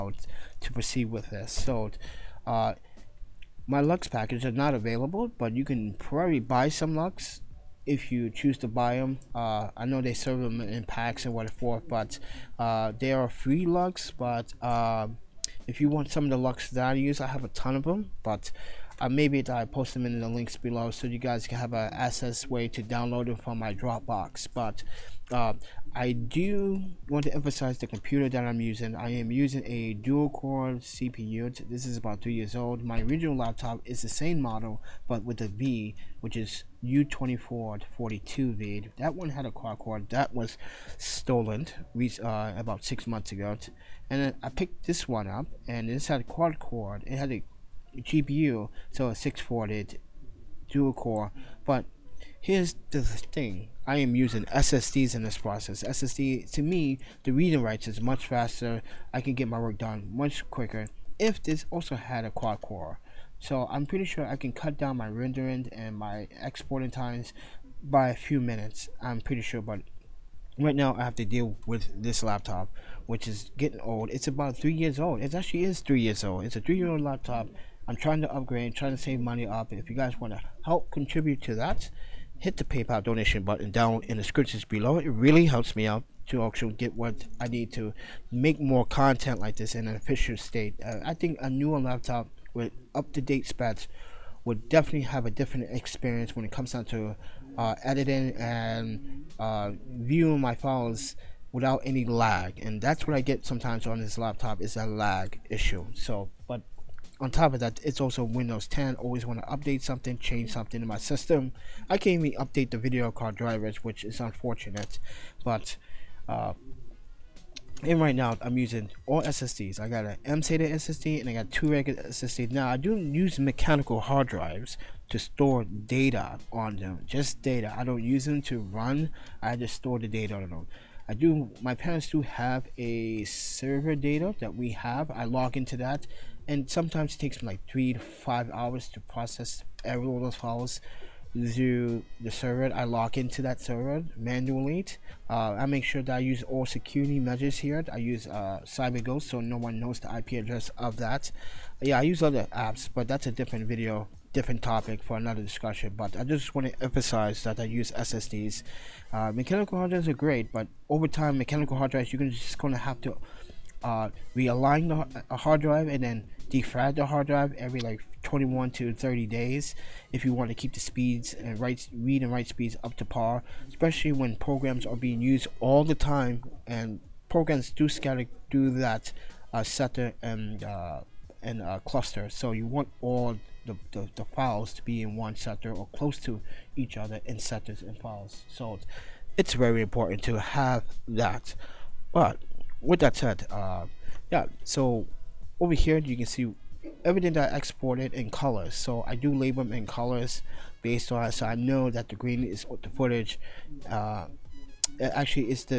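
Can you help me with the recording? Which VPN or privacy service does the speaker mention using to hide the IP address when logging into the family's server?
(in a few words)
CyberGhost.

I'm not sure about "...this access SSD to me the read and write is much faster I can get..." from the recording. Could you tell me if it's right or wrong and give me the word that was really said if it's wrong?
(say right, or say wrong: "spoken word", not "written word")
wrong: "process", not "access".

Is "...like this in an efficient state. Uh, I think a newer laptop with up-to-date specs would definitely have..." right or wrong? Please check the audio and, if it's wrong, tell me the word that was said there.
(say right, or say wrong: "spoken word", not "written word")
right.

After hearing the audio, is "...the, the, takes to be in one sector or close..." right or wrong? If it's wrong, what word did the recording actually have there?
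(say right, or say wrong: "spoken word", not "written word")
wrong: "files", not "takes".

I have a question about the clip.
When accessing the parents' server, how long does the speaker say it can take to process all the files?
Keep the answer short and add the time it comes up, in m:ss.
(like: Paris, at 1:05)
3 to 5 hours, at 2:17.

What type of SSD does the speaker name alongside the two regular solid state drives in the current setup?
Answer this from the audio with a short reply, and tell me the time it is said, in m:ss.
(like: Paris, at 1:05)
mSATA, at 2:00.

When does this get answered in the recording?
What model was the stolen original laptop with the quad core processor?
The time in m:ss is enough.
0:36.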